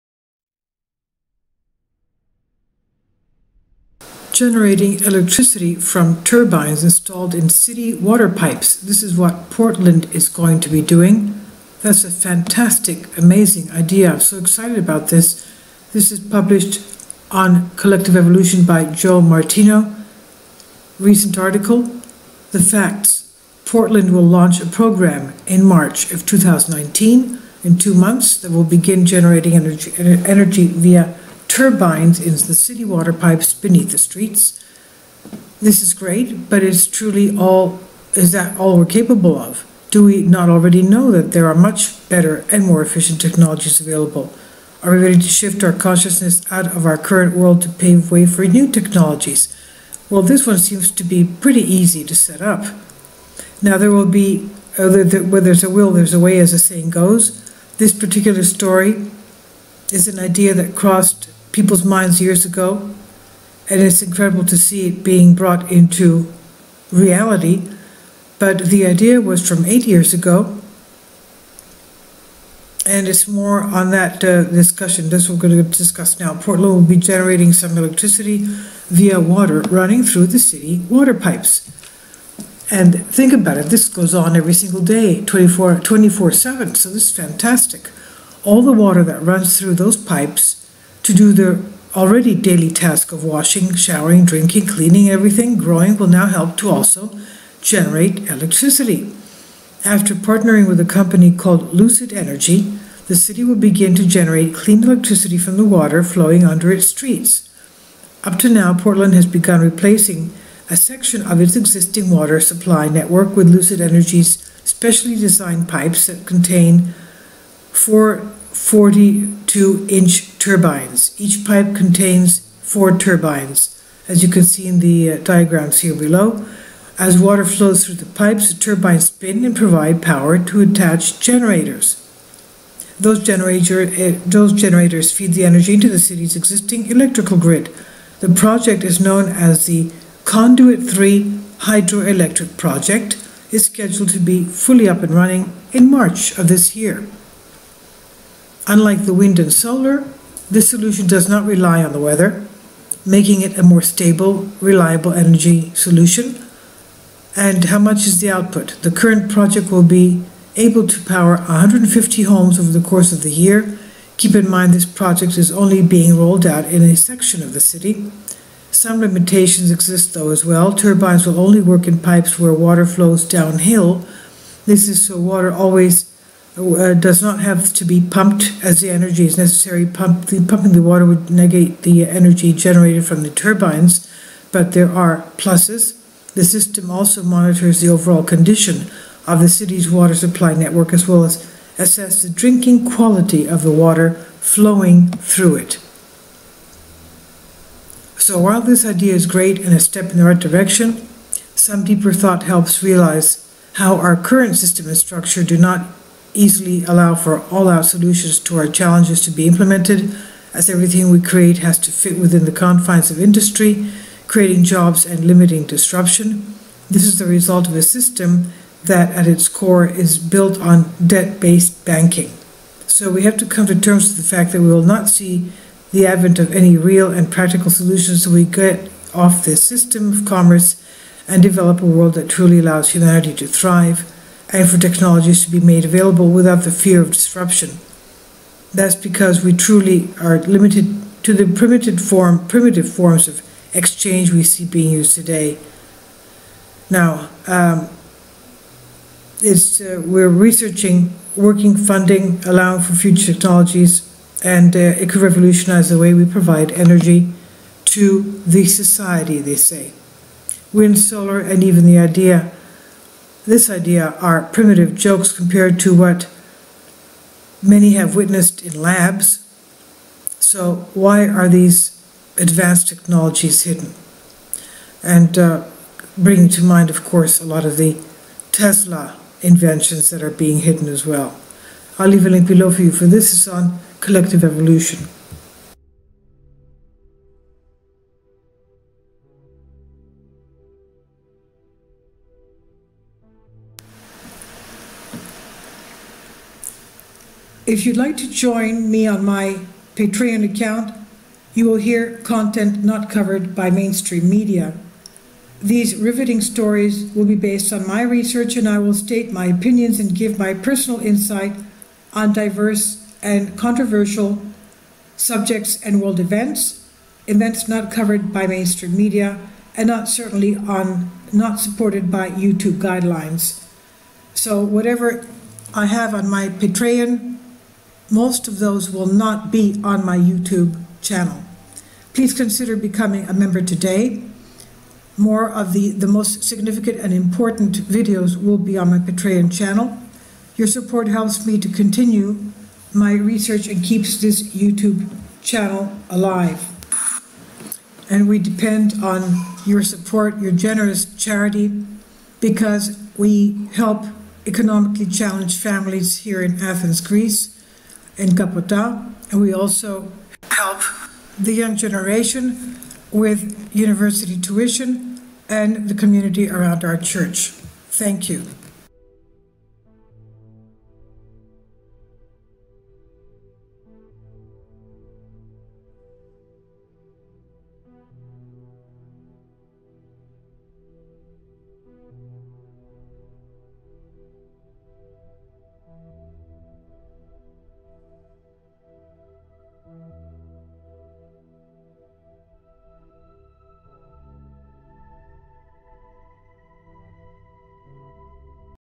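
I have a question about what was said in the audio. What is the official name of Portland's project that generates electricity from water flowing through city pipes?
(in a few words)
Conduit 3 Hydroelectric Project.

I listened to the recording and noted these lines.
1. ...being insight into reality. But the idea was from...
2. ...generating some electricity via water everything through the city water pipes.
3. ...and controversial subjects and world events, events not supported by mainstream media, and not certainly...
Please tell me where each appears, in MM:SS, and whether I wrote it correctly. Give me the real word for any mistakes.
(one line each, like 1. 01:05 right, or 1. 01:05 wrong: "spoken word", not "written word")
1. 01:05 wrong: "brought", not "insight"
2. 01:16 wrong: "running", not "everything"
3. 05:13 wrong: "covered", not "supported".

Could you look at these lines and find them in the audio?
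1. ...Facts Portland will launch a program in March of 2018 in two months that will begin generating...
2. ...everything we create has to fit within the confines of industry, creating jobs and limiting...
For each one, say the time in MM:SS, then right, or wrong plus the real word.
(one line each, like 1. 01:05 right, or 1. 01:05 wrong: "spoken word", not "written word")
1. 00:22 wrong: "2019", not "2018"
2. 03:30 right.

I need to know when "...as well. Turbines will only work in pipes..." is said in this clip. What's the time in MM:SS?
02:50.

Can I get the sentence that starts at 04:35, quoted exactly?
And uh, bringing to mind, of course, a lot of the Tesla inventions that are being hidden as well.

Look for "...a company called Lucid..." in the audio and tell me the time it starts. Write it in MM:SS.
01:40.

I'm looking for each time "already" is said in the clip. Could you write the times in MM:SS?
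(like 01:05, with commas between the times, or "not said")
00:40, 01:31.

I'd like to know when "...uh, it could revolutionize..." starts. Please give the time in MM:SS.
04:14.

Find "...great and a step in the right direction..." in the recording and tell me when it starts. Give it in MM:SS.
03:19.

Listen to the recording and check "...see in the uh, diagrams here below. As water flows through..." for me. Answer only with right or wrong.
right.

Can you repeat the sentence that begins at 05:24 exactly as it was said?
So whatever I have on my Patreon most of those will not be on my YouTube channel.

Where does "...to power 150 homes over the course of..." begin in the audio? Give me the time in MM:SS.
02:40.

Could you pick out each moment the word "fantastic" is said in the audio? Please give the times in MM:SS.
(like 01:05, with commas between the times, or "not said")
00:12, 01:27.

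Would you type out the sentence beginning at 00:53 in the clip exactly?
Now, there will be, uh, where there's a will, there's a way, as the saying goes.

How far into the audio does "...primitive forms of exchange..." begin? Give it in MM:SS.
04:02.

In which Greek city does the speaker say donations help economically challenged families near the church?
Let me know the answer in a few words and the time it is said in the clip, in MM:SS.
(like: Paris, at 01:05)
Athens, at 05:56.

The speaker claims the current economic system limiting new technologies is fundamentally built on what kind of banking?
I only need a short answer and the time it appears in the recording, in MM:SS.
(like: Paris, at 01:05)
debt based banking, at 03:41.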